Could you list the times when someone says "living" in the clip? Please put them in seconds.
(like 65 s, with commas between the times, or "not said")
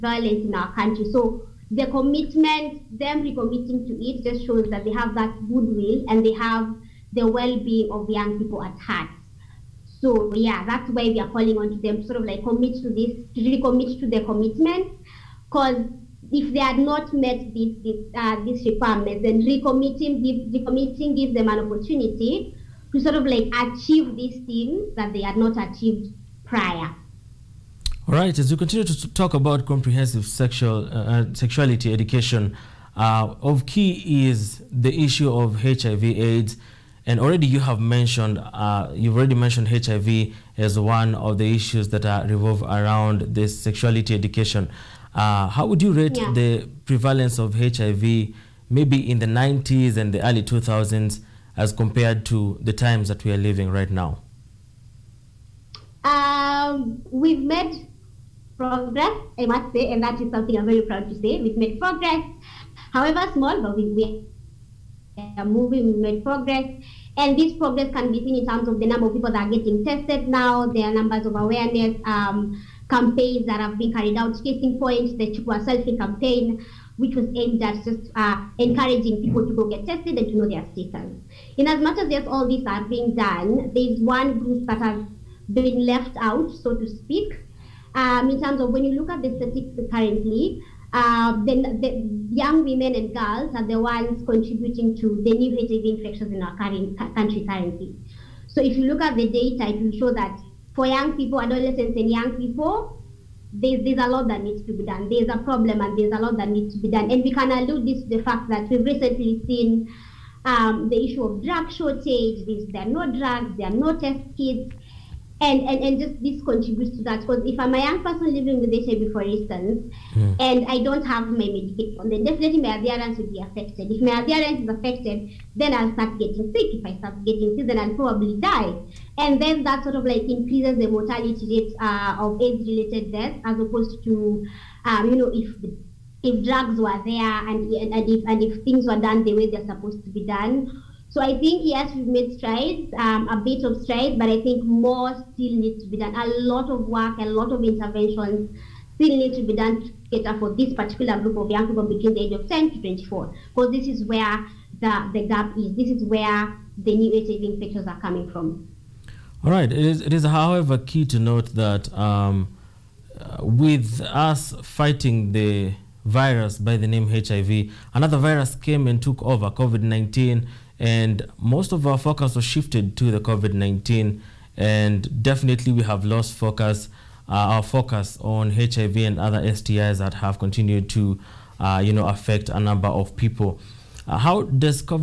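53 s, 118 s.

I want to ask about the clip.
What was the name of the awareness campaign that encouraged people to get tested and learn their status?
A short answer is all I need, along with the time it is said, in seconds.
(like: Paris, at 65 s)
Chukua selfie, at 75 s.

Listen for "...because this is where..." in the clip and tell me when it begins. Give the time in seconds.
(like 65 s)
153 s.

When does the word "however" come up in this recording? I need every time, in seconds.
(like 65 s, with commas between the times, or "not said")
62 s, 160 s.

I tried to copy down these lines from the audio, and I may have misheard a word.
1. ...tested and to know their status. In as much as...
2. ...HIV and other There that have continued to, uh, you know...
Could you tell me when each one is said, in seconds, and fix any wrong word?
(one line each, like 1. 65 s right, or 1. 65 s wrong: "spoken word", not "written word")
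1. 79 s right
2. 178 s wrong: "STIs", not "There".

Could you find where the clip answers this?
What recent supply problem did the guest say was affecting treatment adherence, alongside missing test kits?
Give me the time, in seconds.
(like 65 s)
111 s.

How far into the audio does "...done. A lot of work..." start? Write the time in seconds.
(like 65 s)
145 s.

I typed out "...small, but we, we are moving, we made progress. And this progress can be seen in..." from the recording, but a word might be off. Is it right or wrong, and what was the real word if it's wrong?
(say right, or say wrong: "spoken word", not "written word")
right.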